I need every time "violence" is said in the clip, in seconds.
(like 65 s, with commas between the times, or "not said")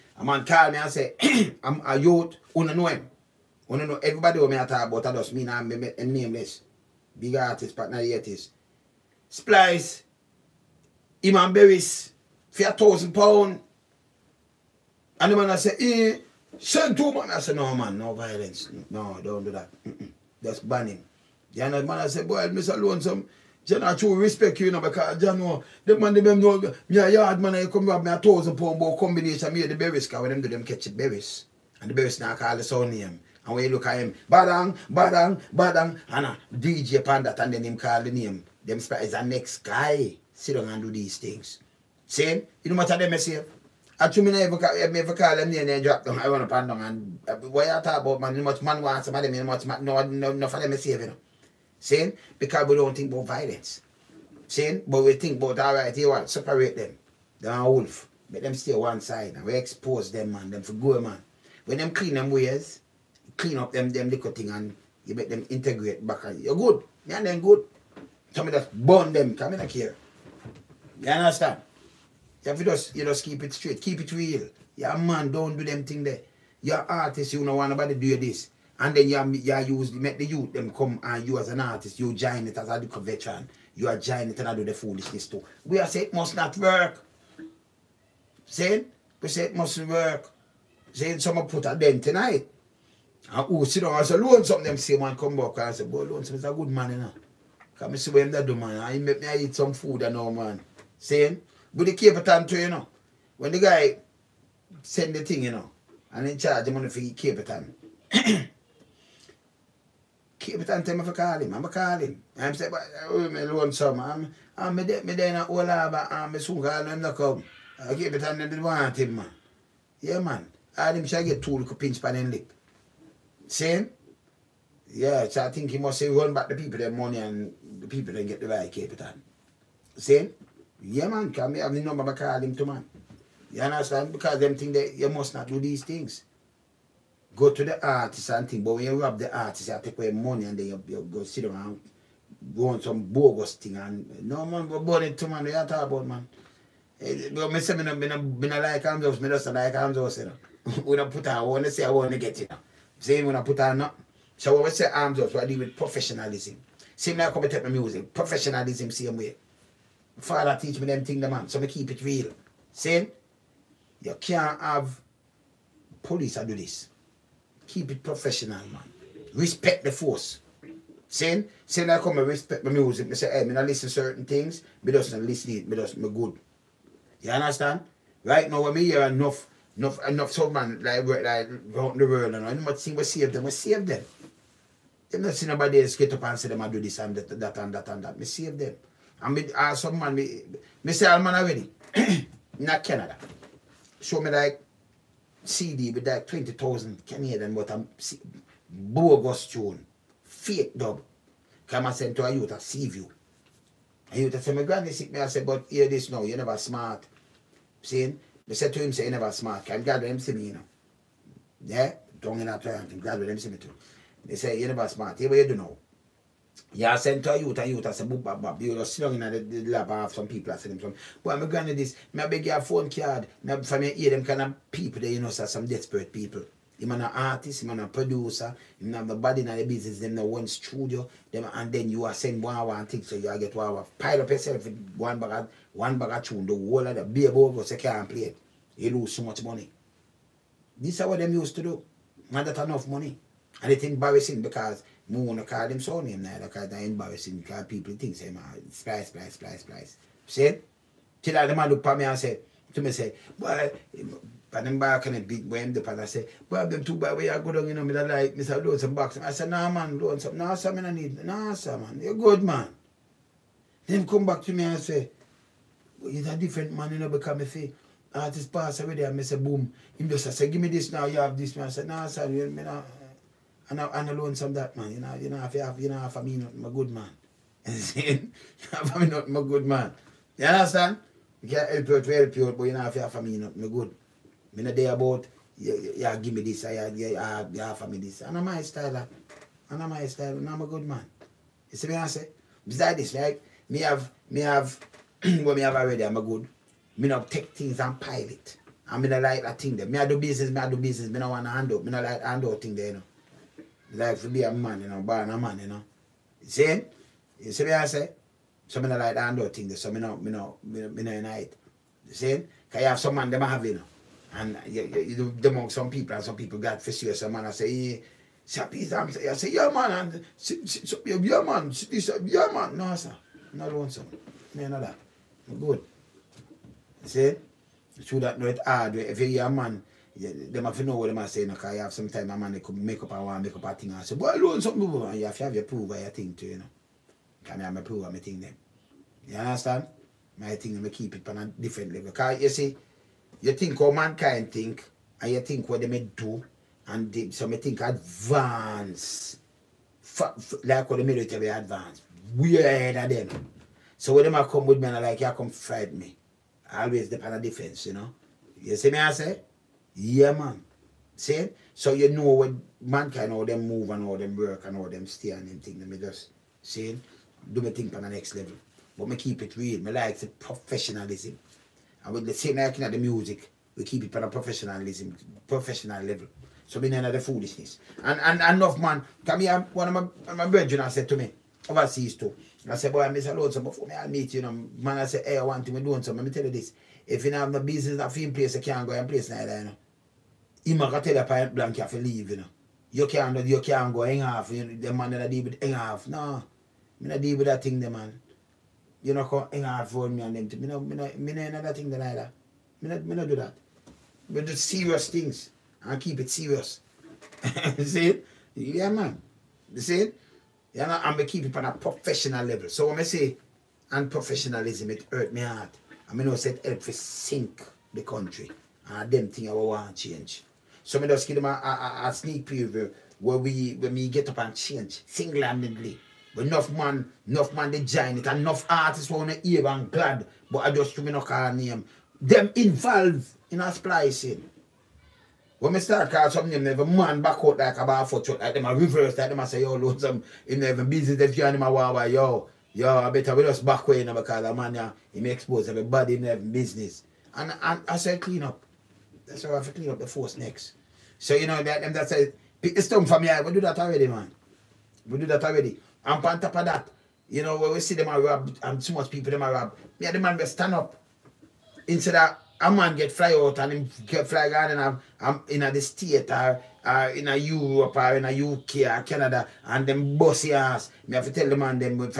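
18 s, 53 s.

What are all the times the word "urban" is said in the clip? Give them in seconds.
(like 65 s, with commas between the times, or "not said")
not said.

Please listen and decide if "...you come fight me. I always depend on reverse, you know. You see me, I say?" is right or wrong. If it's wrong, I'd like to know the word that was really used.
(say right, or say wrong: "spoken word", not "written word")
wrong: "defense", not "reverse".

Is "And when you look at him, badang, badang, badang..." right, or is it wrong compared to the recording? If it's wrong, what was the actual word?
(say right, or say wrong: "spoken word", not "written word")
right.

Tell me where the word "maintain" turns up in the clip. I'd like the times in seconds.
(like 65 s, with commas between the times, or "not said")
not said.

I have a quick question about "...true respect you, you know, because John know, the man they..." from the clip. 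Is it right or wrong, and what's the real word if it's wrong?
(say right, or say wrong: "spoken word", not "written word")
right.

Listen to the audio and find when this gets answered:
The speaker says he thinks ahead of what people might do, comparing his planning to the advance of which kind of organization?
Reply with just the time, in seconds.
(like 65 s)
351 s.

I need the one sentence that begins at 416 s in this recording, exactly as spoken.
I mean, I said help to sink the country.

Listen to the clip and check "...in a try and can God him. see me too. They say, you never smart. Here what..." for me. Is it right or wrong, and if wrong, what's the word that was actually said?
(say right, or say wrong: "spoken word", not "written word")
right.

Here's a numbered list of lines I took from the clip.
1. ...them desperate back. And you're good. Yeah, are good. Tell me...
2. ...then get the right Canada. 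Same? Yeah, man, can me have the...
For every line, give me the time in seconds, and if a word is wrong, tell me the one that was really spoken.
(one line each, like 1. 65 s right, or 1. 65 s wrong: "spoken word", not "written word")
1. 65 s wrong: "integrate", not "desperate"
2. 128 s wrong: "Capleton", not "Canada".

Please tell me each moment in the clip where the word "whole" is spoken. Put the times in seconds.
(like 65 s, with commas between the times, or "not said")
115 s, 236 s.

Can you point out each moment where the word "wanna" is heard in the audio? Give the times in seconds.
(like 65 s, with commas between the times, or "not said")
2 s, 429 s.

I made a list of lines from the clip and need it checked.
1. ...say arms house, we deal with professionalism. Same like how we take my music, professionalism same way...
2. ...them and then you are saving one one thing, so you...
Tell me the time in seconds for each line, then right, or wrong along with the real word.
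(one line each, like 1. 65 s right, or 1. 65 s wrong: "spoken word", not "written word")
1. 154 s right
2. 231 s wrong: "sending", not "saving".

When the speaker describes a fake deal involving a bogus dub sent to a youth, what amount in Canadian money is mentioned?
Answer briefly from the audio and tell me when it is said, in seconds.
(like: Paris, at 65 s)
20,000 Canadian, at 196 s.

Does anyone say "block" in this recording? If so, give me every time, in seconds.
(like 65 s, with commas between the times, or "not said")
not said.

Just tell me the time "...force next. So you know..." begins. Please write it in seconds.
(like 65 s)
450 s.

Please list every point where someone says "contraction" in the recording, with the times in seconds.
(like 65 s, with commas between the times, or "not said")
not said.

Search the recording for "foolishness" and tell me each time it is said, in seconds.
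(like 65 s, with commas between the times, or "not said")
84 s, 377 s.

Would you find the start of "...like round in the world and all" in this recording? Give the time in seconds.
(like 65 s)
181 s.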